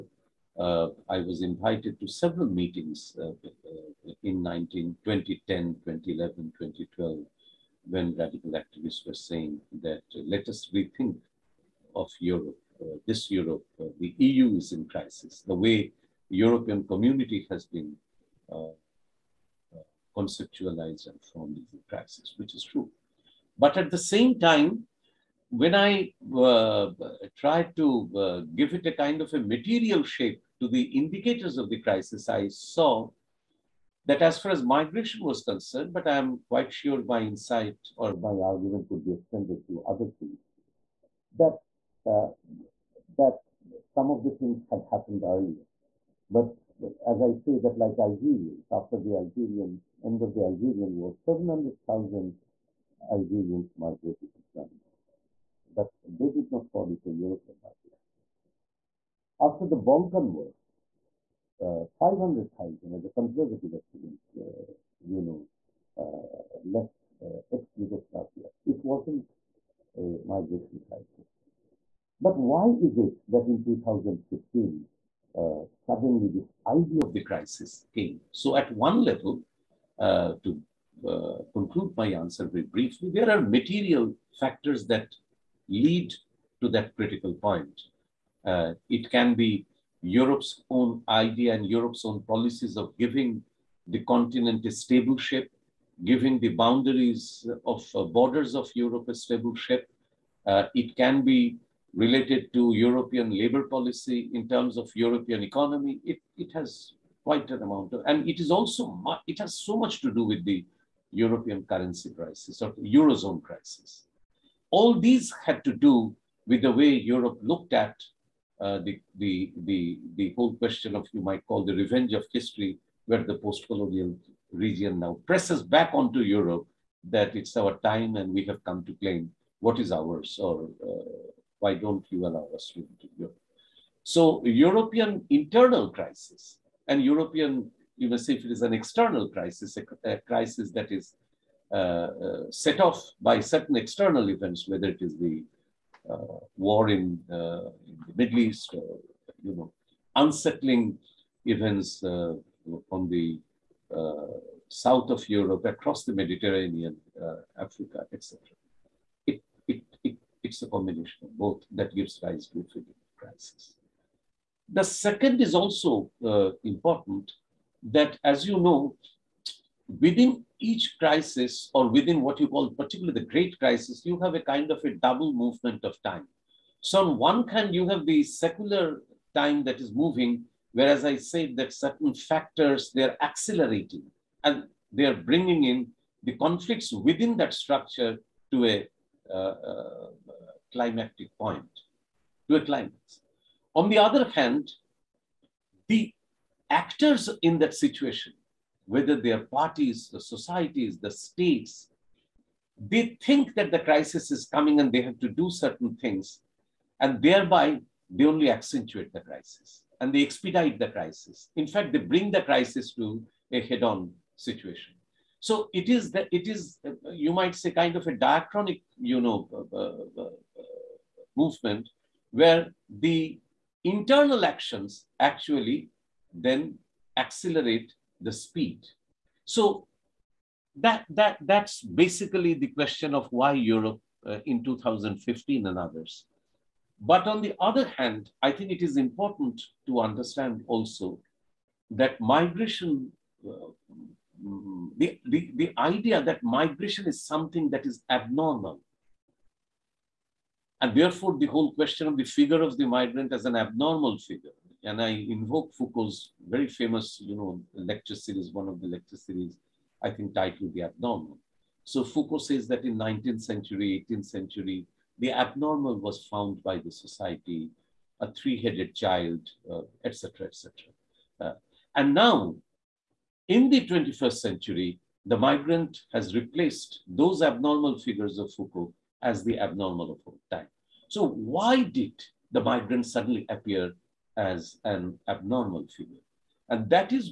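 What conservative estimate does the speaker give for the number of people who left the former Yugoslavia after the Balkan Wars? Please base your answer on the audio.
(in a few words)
500,000.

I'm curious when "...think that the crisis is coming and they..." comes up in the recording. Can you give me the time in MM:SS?
03:23.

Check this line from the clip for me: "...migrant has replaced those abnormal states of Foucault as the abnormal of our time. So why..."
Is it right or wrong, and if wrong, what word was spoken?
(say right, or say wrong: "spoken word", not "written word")
wrong: "figures", not "states".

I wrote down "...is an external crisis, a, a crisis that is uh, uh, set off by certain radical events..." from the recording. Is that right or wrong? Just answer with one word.
wrong.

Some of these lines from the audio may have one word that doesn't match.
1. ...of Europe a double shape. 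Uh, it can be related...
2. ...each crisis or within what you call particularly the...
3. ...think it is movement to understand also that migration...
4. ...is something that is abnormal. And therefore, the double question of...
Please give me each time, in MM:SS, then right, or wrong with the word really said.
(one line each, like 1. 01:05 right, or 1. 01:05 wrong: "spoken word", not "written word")
1. 01:38 wrong: "stable", not "double"
2. 02:50 right
3. 03:58 wrong: "important", not "movement"
4. 04:07 wrong: "whole", not "double".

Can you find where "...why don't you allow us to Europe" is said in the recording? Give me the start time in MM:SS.
02:11.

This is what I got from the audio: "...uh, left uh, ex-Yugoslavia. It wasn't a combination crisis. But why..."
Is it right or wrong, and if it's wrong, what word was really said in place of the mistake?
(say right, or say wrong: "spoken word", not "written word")
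wrong: "migration", not "combination".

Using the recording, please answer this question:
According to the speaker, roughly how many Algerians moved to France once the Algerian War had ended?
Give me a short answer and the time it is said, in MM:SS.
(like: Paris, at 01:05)
700,000, at 00:51.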